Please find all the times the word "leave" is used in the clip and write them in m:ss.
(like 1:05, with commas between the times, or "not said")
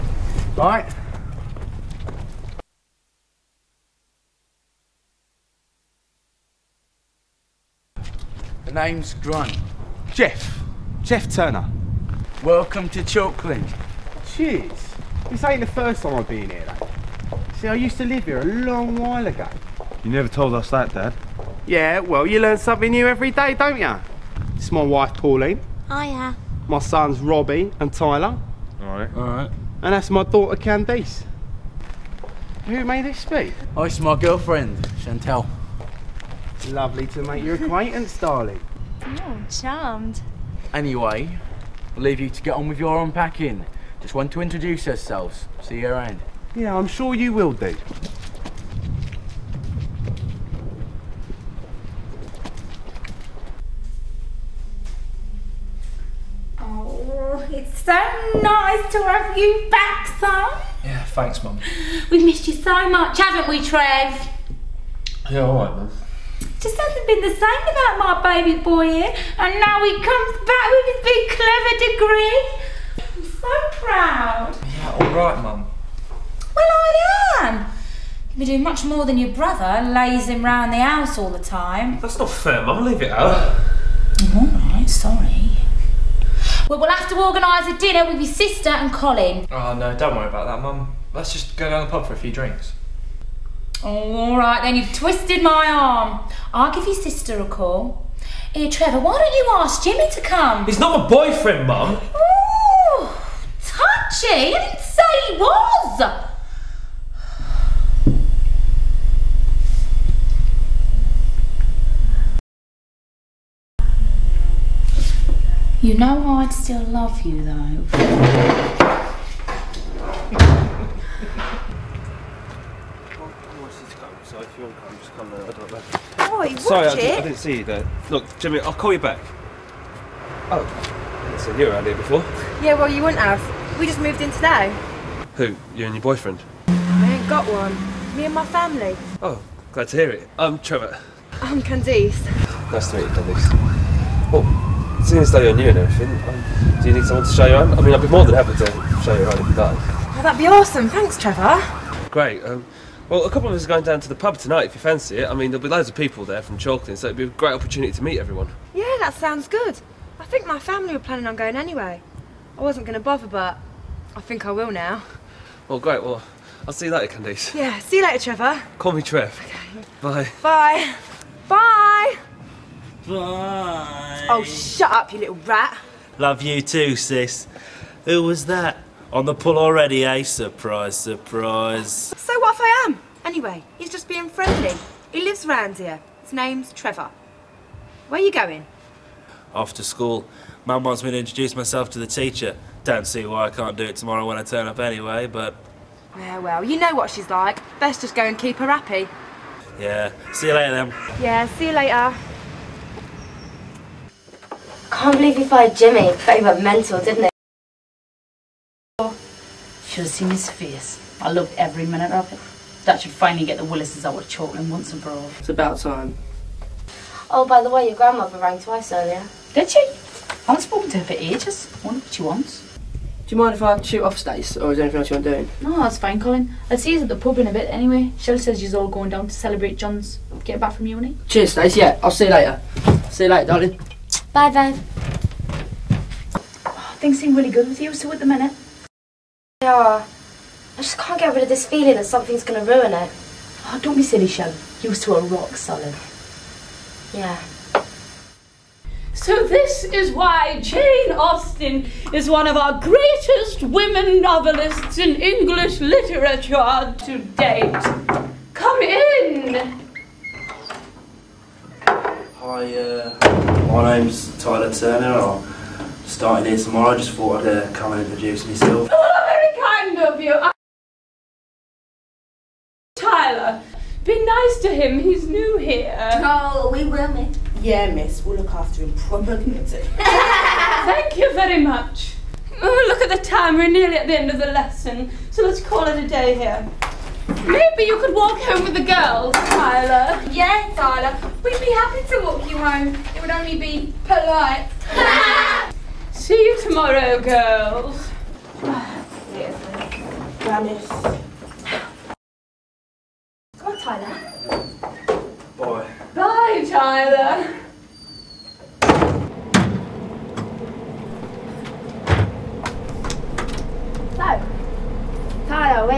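0:42, 1:22.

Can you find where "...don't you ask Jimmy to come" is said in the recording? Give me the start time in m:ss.
1:39.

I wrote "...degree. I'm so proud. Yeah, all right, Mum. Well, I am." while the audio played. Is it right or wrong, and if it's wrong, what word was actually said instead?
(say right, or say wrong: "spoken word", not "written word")
right.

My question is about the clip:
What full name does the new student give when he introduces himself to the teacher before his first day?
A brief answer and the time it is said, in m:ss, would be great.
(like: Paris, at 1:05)
Tyler Turner, at 4:24.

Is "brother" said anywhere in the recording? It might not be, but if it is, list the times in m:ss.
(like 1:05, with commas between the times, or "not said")
1:19.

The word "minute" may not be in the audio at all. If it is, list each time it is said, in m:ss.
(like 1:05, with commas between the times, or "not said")
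3:31, 3:58.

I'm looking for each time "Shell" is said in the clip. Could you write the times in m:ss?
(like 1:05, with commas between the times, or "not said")
3:48, 4:04.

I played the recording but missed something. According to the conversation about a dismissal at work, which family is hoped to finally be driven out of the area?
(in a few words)
The Willises.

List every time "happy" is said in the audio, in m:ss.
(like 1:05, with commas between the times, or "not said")
2:28, 3:18, 4:51.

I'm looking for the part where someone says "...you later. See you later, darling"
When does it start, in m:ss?
3:52.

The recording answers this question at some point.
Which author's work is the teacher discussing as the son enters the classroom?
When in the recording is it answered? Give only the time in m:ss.
4:10.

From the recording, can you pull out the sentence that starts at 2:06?
Oi, watch Sorry, I, didn't- I didn't see you there.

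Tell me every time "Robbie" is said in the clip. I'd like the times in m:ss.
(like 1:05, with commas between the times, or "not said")
0:27.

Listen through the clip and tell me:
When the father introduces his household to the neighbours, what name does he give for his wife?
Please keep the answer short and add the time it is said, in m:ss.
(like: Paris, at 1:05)
Pauline, at 0:25.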